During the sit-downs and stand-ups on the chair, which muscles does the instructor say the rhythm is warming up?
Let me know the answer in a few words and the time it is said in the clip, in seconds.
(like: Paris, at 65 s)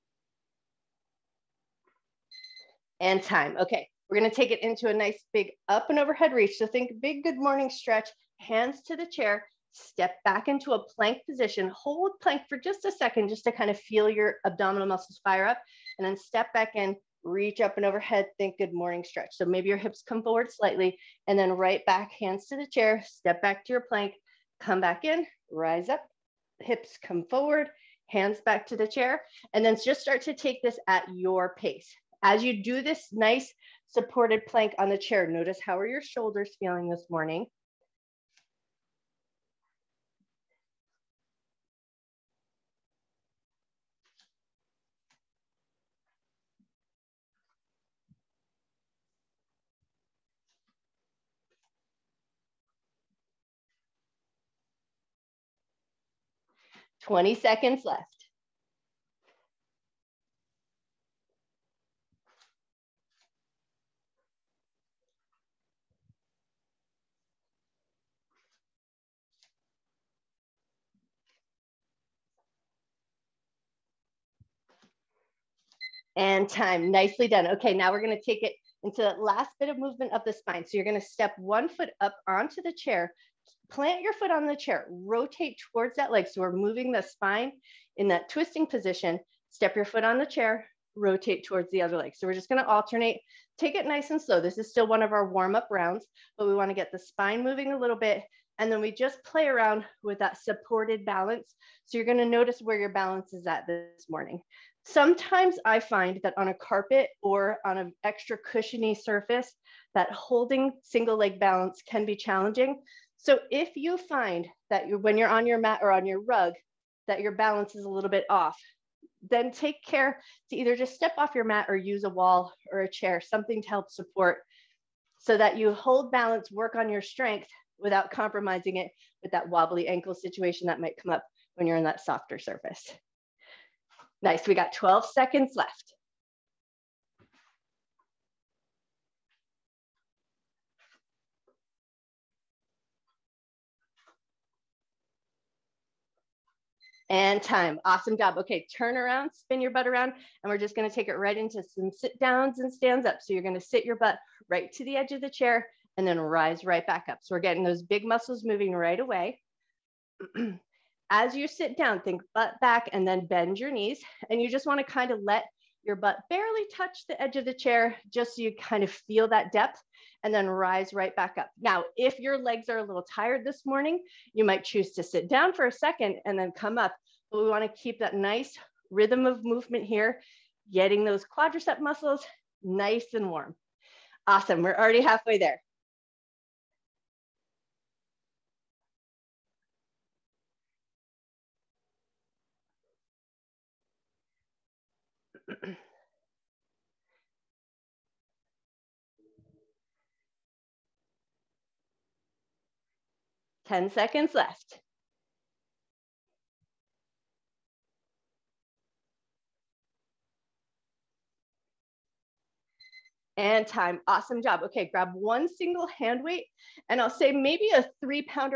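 quadricep muscles, at 181 s.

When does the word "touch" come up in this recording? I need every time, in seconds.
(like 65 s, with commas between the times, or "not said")
166 s.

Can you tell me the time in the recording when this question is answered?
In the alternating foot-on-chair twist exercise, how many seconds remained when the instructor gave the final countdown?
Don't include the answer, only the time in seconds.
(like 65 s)
134 s.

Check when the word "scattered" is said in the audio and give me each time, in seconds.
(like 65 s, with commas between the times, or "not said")
not said.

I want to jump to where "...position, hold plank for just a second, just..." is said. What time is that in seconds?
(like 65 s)
11 s.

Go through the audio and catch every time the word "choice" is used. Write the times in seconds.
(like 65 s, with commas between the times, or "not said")
not said.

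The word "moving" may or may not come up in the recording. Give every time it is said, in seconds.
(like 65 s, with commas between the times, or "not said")
86 s, 97 s, 158 s.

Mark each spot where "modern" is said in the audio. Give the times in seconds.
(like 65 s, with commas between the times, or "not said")
not said.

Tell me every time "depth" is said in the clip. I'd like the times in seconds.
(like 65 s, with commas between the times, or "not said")
169 s.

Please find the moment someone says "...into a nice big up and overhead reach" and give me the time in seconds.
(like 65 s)
4 s.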